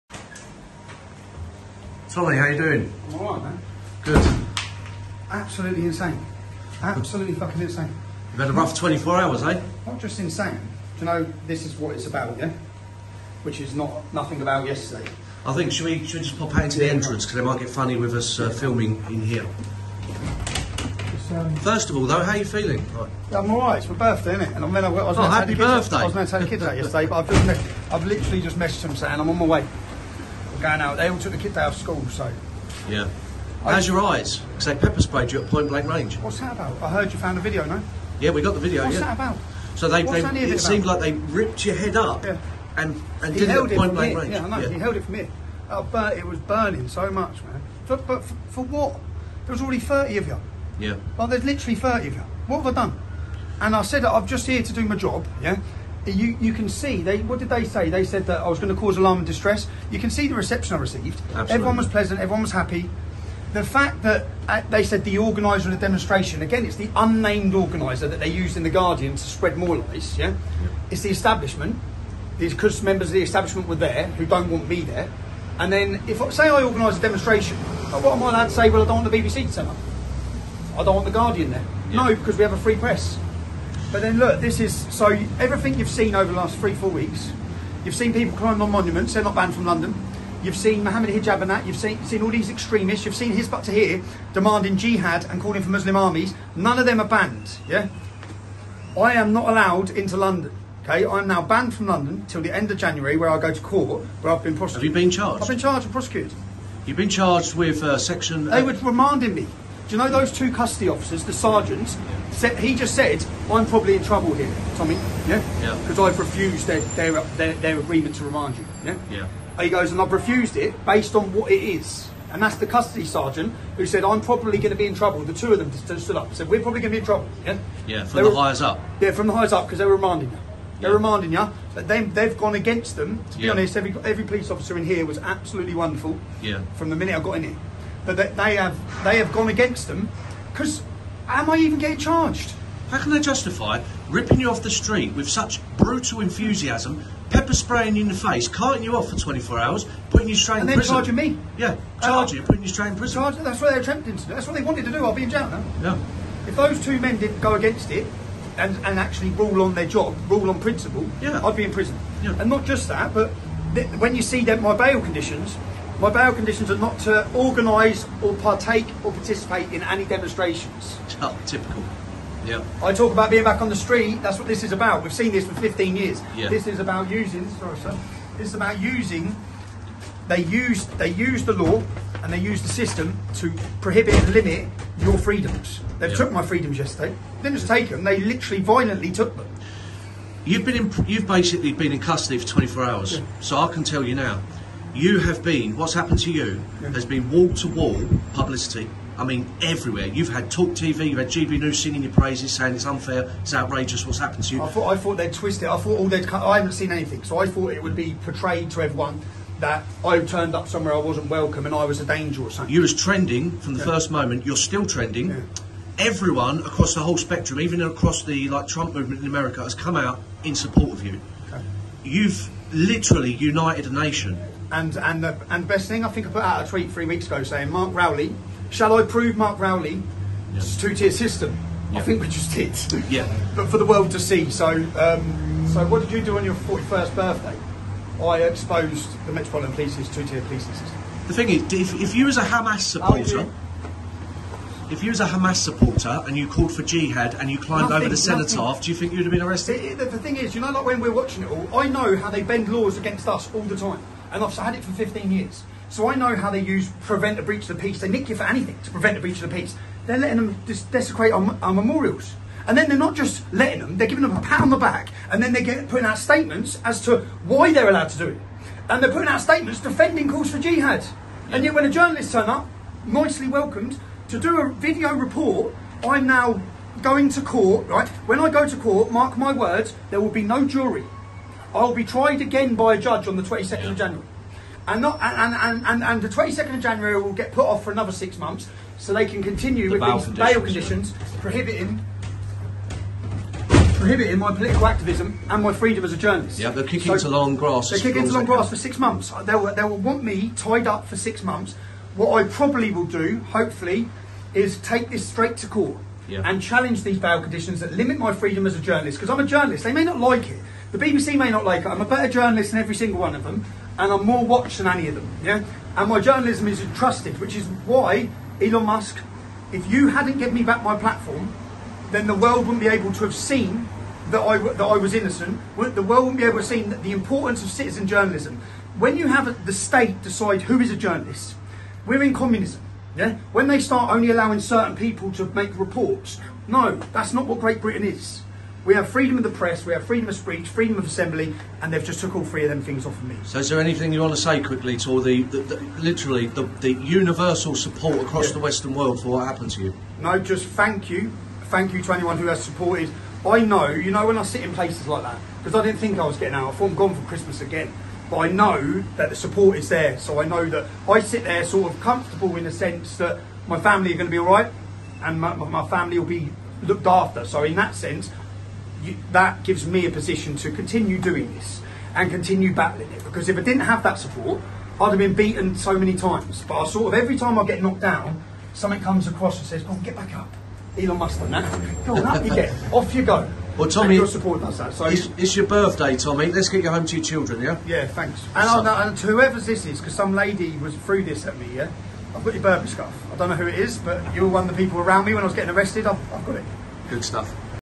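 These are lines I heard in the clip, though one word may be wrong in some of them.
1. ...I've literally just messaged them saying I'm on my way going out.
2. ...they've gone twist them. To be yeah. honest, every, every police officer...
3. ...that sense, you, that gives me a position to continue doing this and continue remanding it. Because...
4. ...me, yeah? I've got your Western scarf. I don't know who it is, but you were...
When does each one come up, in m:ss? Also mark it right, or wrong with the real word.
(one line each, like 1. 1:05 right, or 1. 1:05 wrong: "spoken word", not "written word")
1. 0:27 right
2. 2:12 wrong: "against", not "twist"
3. 6:07 wrong: "battling", not "remanding"
4. 6:31 wrong: "Burberry", not "Western".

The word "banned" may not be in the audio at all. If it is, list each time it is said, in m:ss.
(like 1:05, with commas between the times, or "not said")
1:29, 1:37, 1:41.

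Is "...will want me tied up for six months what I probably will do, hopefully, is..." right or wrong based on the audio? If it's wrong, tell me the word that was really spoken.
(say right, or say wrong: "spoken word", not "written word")
right.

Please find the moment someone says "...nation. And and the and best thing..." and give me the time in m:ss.
3:43.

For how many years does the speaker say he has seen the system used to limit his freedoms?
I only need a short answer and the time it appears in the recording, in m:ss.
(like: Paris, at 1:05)
15, at 2:55.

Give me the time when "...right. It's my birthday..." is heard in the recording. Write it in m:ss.
0:23.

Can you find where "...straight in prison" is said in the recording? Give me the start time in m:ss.
2:32.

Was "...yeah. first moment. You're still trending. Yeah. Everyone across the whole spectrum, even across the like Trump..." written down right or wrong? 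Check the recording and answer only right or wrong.
right.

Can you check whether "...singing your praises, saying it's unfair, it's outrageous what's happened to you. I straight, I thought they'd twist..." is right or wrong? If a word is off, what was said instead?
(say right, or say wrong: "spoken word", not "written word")
wrong: "thought", not "straight".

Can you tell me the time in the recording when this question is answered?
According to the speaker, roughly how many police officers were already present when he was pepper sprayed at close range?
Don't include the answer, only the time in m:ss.
0:49.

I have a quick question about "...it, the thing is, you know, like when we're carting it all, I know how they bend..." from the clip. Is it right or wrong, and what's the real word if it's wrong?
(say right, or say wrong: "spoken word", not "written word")
wrong: "watching", not "carting".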